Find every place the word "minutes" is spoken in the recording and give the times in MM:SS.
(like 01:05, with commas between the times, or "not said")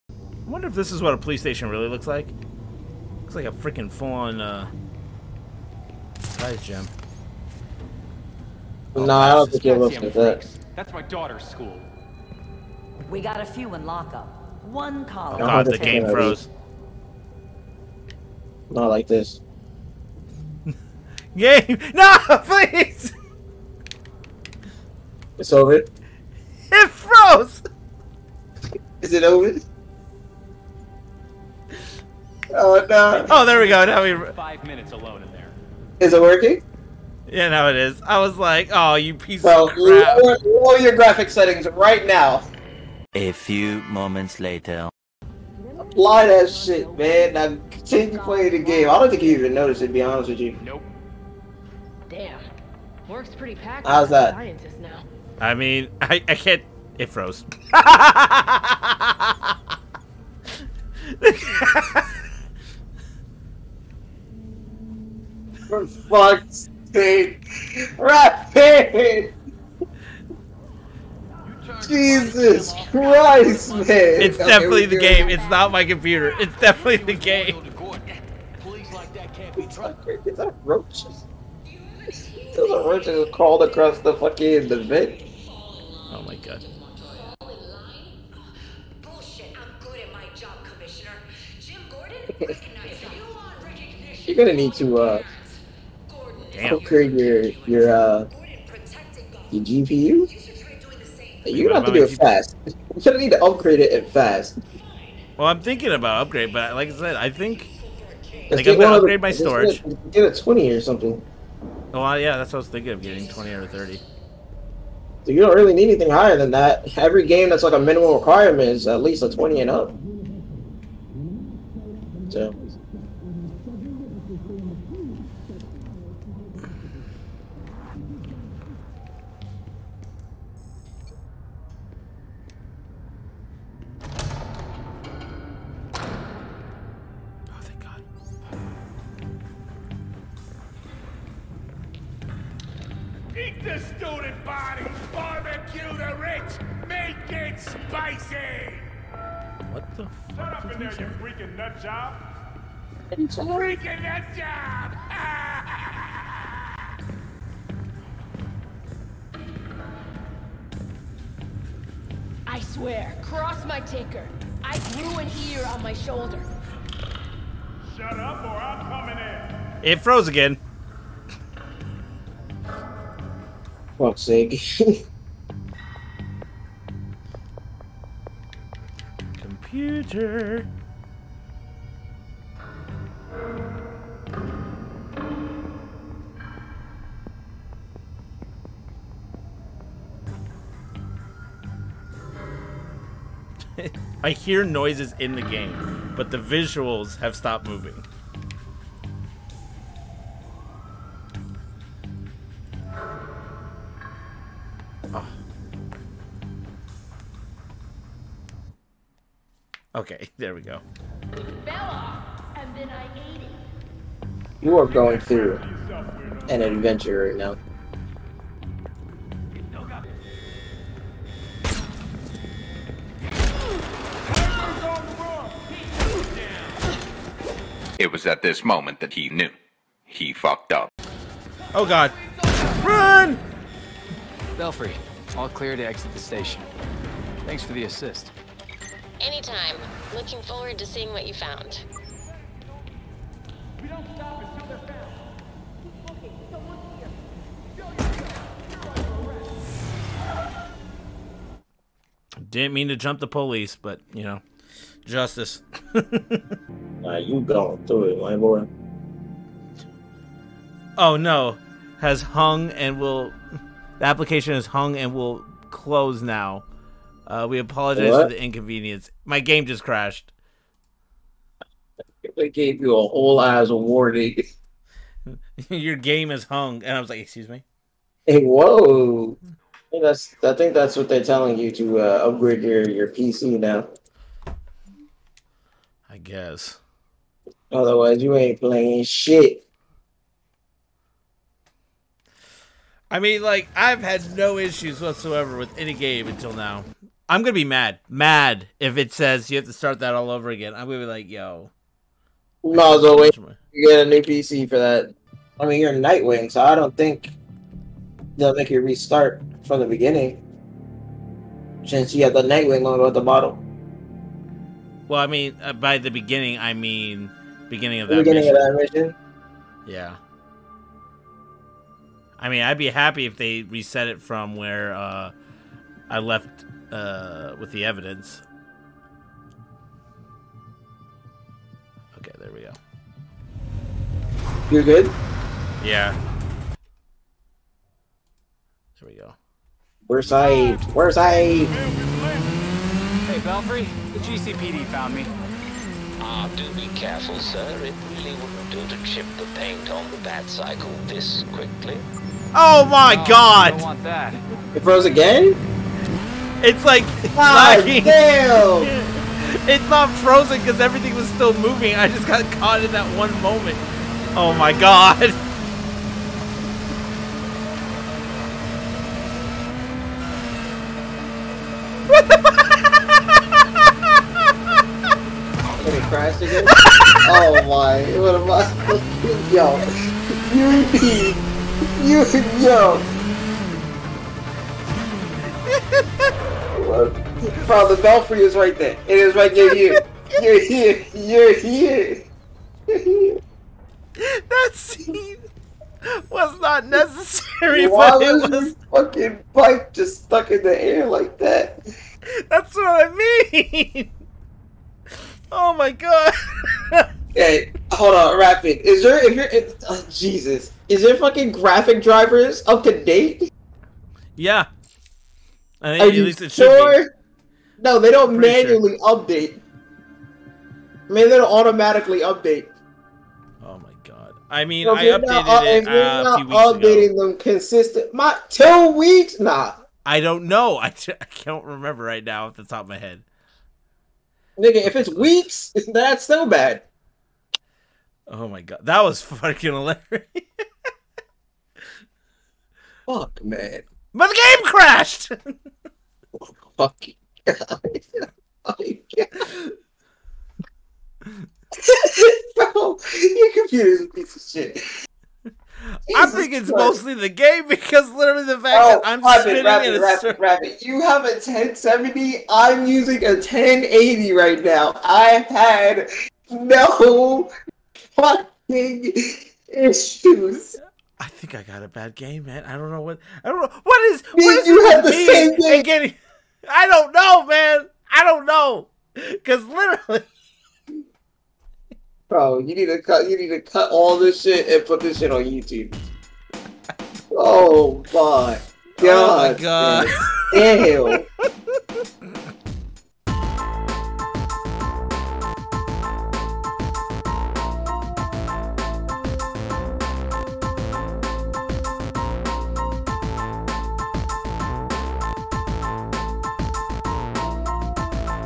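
00:34.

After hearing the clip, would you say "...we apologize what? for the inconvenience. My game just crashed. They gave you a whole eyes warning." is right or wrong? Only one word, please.
right.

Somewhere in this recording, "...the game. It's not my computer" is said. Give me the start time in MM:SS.
01:14.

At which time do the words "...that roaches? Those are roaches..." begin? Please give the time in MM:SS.
01:20.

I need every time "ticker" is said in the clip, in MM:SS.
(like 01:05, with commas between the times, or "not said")
02:43.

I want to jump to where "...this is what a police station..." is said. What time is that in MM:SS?
00:00.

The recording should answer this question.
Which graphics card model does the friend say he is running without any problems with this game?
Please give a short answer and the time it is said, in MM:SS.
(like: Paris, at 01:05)
1080, at 07:43.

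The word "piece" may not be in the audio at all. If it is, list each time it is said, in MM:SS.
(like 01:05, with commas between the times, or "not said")
00:39, 07:34.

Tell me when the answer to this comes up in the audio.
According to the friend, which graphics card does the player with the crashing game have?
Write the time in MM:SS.
07:41.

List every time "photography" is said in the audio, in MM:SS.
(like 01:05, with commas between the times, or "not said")
not said.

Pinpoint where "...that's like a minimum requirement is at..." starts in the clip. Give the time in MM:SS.
01:57.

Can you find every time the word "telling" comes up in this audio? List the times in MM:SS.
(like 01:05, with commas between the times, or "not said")
04:41.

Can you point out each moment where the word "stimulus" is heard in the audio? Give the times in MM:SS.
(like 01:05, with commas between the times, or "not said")
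not said.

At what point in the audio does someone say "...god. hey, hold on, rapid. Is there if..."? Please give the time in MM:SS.
06:45.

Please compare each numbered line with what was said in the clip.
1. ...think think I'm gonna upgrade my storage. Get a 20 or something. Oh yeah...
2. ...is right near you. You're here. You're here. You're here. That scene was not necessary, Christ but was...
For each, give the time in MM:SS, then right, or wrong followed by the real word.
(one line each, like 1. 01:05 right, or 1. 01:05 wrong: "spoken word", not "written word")
1. 01:47 right
2. 06:29 wrong: "Why", not "Christ".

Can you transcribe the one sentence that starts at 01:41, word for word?
You're gonna have to do it fast.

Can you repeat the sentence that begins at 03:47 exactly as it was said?
It was at this moment that he knew.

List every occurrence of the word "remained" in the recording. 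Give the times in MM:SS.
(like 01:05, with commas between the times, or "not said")
not said.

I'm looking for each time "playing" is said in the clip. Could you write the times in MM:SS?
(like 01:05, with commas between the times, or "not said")
00:48, 04:48.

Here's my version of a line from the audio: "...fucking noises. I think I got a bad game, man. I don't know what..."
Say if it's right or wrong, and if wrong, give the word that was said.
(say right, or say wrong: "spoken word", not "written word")
wrong: "issues", not "noises".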